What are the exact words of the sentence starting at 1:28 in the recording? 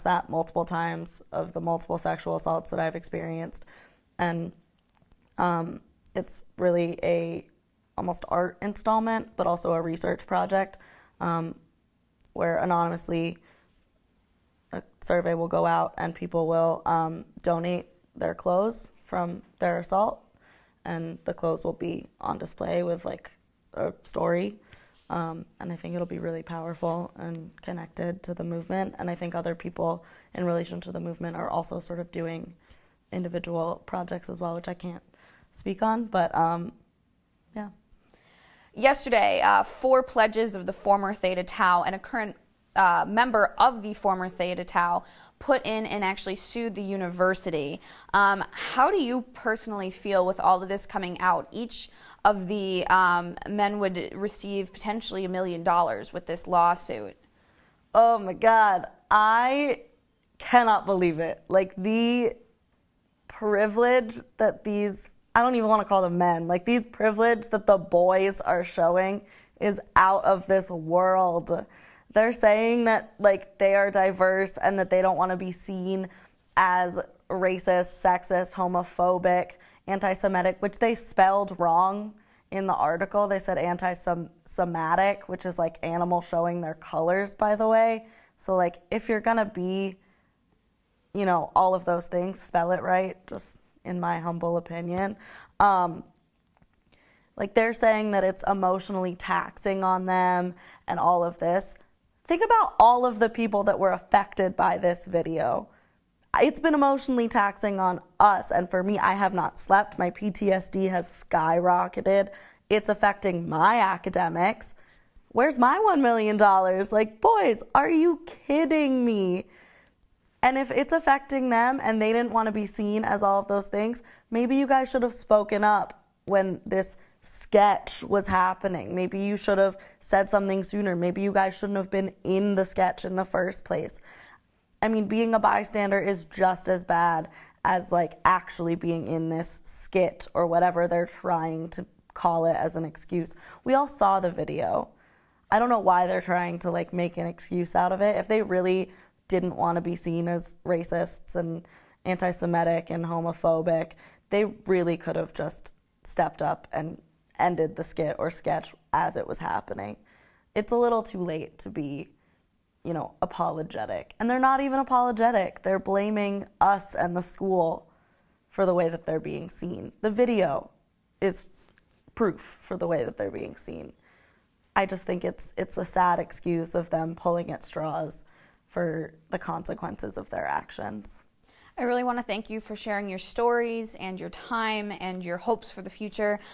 So, like, if you're gonna be, you know, all of those things, spell it right, just in my humble opinion.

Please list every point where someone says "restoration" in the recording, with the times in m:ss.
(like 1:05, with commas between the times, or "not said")
not said.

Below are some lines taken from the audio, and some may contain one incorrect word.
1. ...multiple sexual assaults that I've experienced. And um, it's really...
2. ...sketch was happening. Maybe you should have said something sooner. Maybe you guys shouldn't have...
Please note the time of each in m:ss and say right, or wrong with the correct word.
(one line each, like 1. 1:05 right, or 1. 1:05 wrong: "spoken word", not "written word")
1. 0:01 right
2. 2:07 right.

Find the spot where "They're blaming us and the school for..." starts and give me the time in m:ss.
2:45.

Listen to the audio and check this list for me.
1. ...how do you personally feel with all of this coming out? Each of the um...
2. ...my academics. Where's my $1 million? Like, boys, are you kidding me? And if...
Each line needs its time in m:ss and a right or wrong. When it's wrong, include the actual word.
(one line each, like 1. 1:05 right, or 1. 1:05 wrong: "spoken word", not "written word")
1. 0:48 right
2. 1:53 right.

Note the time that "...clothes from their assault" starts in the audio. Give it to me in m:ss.
0:18.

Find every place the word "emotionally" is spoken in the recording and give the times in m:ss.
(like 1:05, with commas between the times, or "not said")
1:38, 1:46.